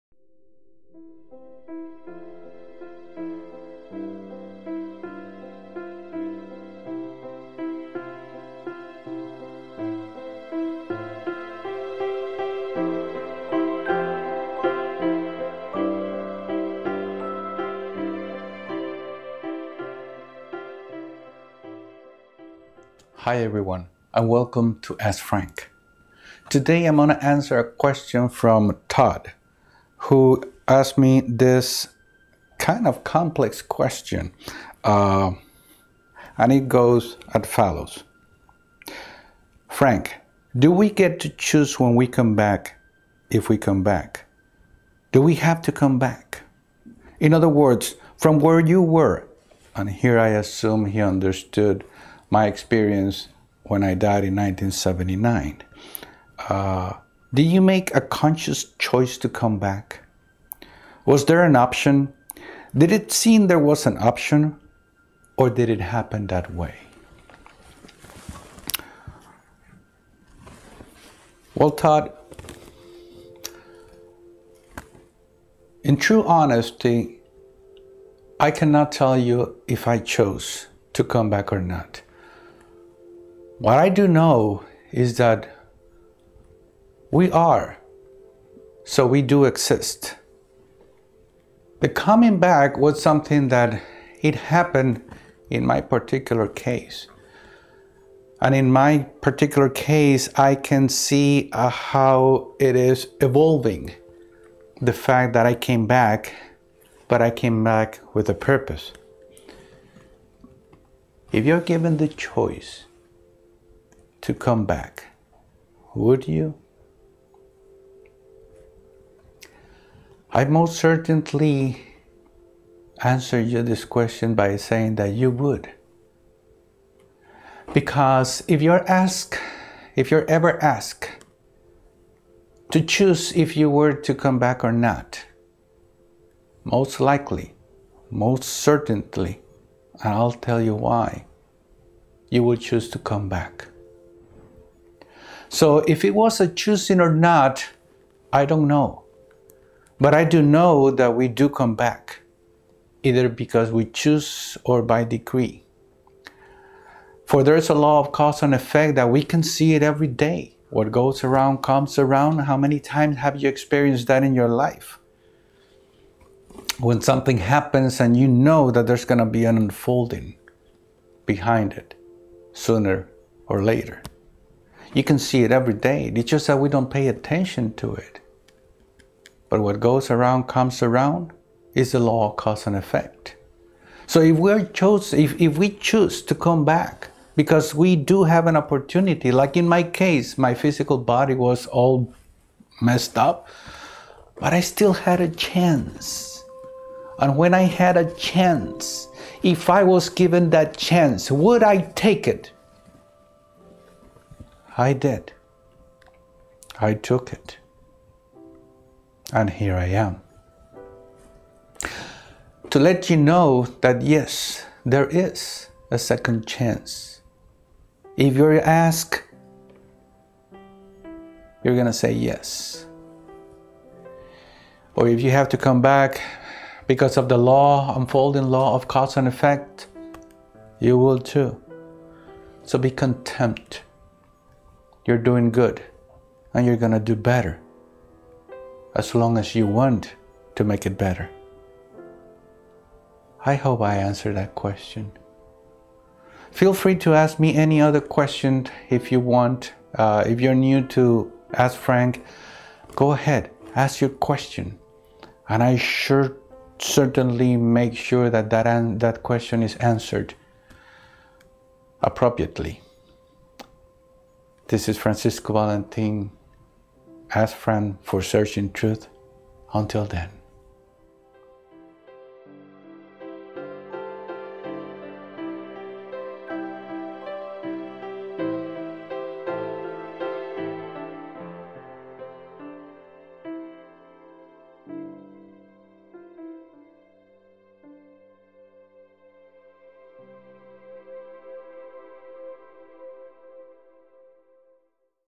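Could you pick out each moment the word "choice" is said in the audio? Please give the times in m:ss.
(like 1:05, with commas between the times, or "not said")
0:58, 1:52.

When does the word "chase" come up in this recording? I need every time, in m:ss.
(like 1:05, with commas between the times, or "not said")
not said.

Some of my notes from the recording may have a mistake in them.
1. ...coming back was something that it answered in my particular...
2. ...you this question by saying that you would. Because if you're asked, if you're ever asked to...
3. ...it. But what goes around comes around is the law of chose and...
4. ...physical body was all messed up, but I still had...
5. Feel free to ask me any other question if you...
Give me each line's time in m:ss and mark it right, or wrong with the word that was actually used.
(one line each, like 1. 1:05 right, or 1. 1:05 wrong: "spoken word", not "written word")
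1. 1:31 wrong: "happened", not "answered"
2. 2:03 right
3. 2:57 wrong: "cause", not "chose"
4. 3:10 right
5. 4:06 right.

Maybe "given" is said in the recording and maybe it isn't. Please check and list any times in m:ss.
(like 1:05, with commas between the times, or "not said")
1:51, 3:20.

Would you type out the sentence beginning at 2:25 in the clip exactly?
So if it was a choosing or not, I don't know.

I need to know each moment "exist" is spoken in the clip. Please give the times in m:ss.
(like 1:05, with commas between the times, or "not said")
1:29.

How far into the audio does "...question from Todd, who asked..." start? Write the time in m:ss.
0:27.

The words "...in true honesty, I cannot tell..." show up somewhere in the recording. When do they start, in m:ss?
1:15.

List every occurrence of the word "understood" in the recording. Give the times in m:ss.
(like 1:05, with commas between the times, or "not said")
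0:50.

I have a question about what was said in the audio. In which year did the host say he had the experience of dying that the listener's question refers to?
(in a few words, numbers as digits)
1979.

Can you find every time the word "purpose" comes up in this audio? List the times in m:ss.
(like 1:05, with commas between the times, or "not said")
1:48.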